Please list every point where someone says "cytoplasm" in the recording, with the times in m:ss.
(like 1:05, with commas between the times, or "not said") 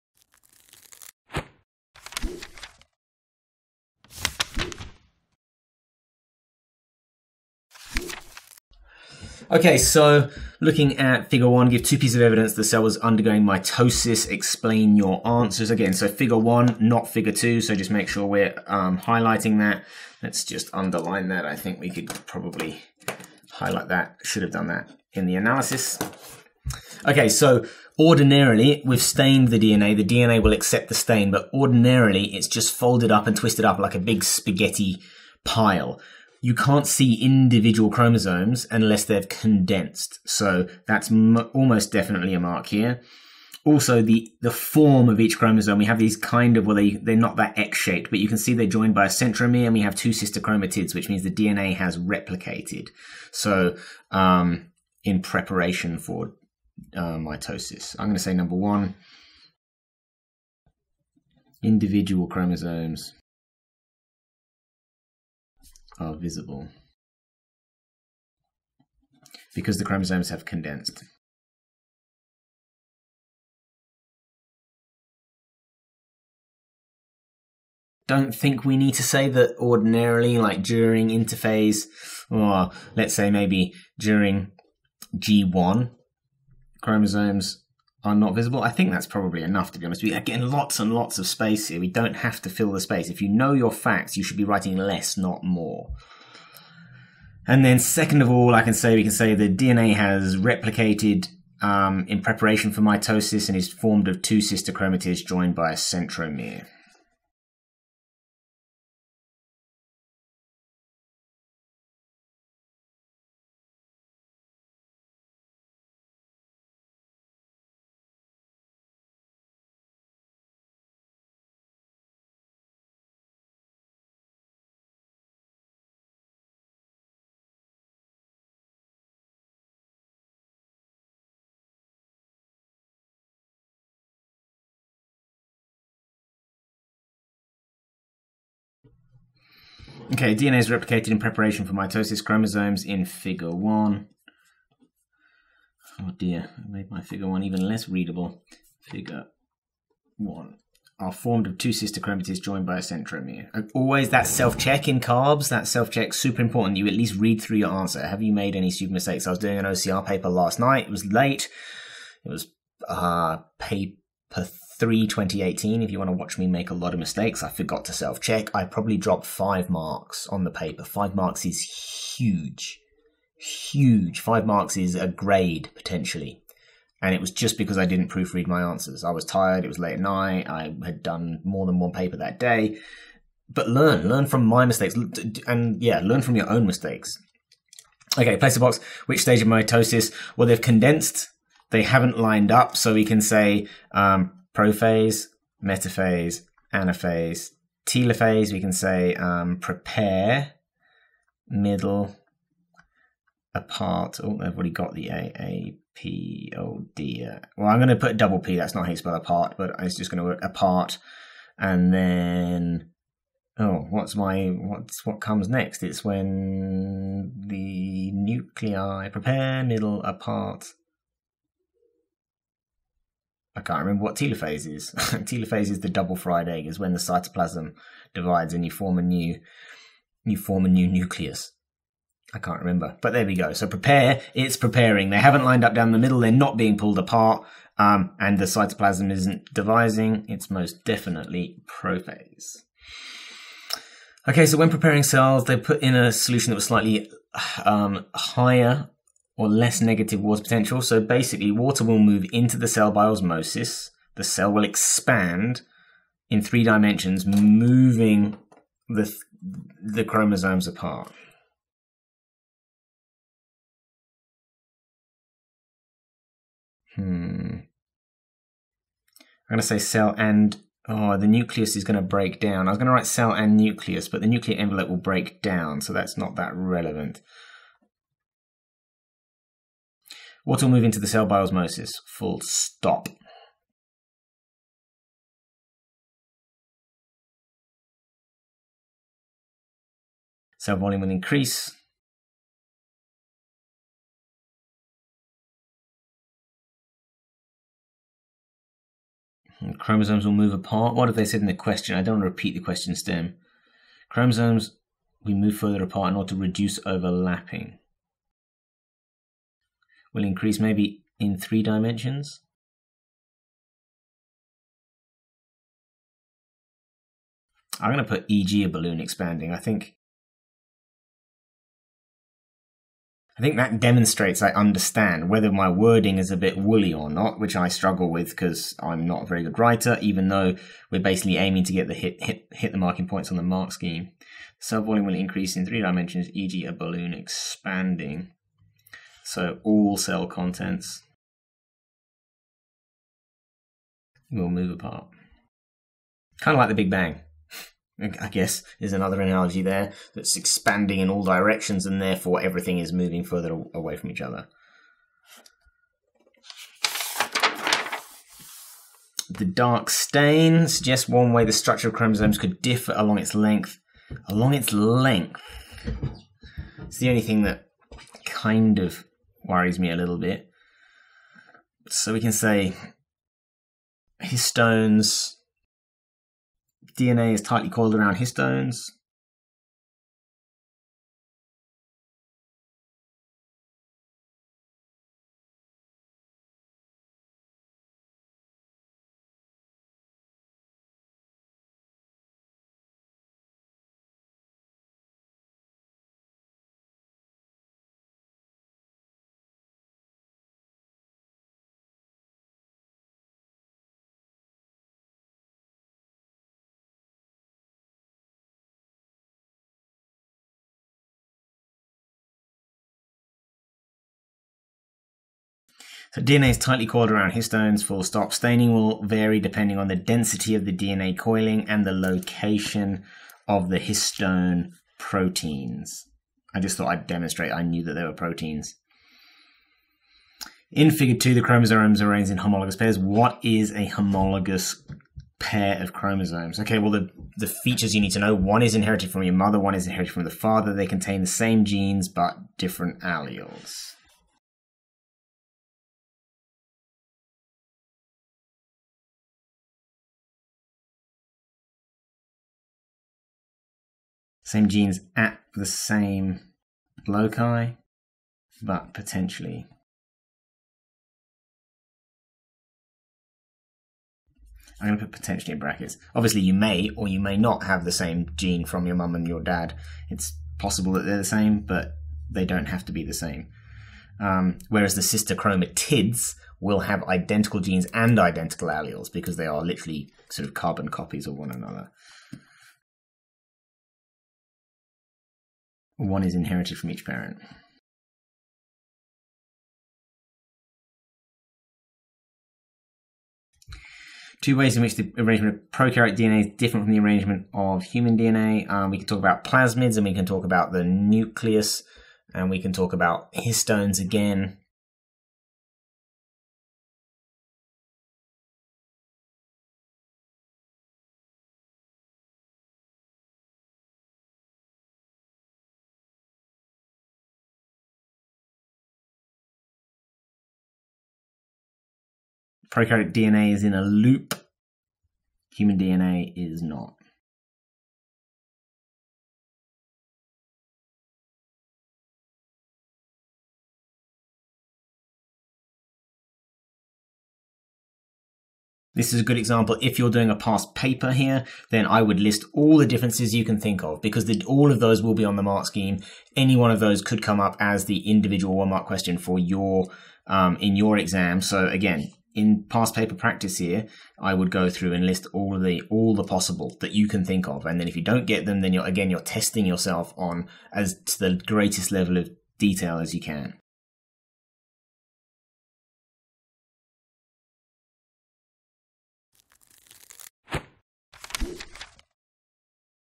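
3:46, 3:58.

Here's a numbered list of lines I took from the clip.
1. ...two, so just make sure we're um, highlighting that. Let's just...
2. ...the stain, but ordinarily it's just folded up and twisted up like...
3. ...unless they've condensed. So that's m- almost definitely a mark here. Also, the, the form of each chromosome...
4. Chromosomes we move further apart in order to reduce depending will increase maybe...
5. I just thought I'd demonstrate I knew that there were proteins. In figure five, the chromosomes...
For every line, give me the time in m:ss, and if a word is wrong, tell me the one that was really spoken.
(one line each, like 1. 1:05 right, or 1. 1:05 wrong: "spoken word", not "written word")
1. 0:17 right
2. 0:30 right
3. 0:38 right
4. 5:04 wrong: "overlapping", not "depending"
5. 7:06 wrong: "two", not "five".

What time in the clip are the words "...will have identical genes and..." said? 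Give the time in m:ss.
7:56.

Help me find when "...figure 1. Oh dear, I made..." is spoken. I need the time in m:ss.
2:23.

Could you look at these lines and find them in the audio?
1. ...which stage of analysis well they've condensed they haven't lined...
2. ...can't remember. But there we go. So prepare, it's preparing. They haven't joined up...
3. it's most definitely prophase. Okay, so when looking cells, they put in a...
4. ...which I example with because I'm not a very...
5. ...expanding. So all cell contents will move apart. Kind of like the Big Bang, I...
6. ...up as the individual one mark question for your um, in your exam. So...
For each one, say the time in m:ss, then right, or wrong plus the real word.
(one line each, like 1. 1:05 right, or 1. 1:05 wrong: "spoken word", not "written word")
1. 3:09 wrong: "mitosis", not "analysis"
2. 3:52 wrong: "lined", not "joined"
3. 4:00 wrong: "preparing", not "looking"
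4. 5:27 wrong: "struggle", not "example"
5. 5:37 right
6. 9:07 right.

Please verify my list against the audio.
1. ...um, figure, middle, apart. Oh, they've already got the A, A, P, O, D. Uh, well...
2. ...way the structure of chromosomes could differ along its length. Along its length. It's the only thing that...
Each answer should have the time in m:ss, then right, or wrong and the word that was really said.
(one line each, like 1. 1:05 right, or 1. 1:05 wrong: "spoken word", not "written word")
1. 3:19 wrong: "prepare", not "figure"
2. 6:01 right.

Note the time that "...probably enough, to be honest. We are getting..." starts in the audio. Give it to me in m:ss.
1:29.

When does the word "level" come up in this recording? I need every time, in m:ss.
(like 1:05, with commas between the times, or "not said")
9:21.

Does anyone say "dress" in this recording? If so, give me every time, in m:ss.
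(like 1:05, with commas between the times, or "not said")
not said.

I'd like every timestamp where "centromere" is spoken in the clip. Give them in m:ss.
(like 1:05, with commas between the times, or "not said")
0:49, 1:45, 2:32.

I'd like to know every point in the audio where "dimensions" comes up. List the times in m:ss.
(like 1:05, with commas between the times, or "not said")
4:16, 5:11, 5:35.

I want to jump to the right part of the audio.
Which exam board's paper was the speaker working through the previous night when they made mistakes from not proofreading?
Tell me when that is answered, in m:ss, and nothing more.
2:39.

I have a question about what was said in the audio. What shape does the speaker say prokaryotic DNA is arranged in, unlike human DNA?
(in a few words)
A loop.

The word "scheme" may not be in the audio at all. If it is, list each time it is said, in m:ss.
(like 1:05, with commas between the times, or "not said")
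5:33, 9:05.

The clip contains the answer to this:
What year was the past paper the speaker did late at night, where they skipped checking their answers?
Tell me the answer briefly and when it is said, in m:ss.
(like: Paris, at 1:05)
2018, at 2:45.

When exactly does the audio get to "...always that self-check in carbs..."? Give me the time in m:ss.
2:33.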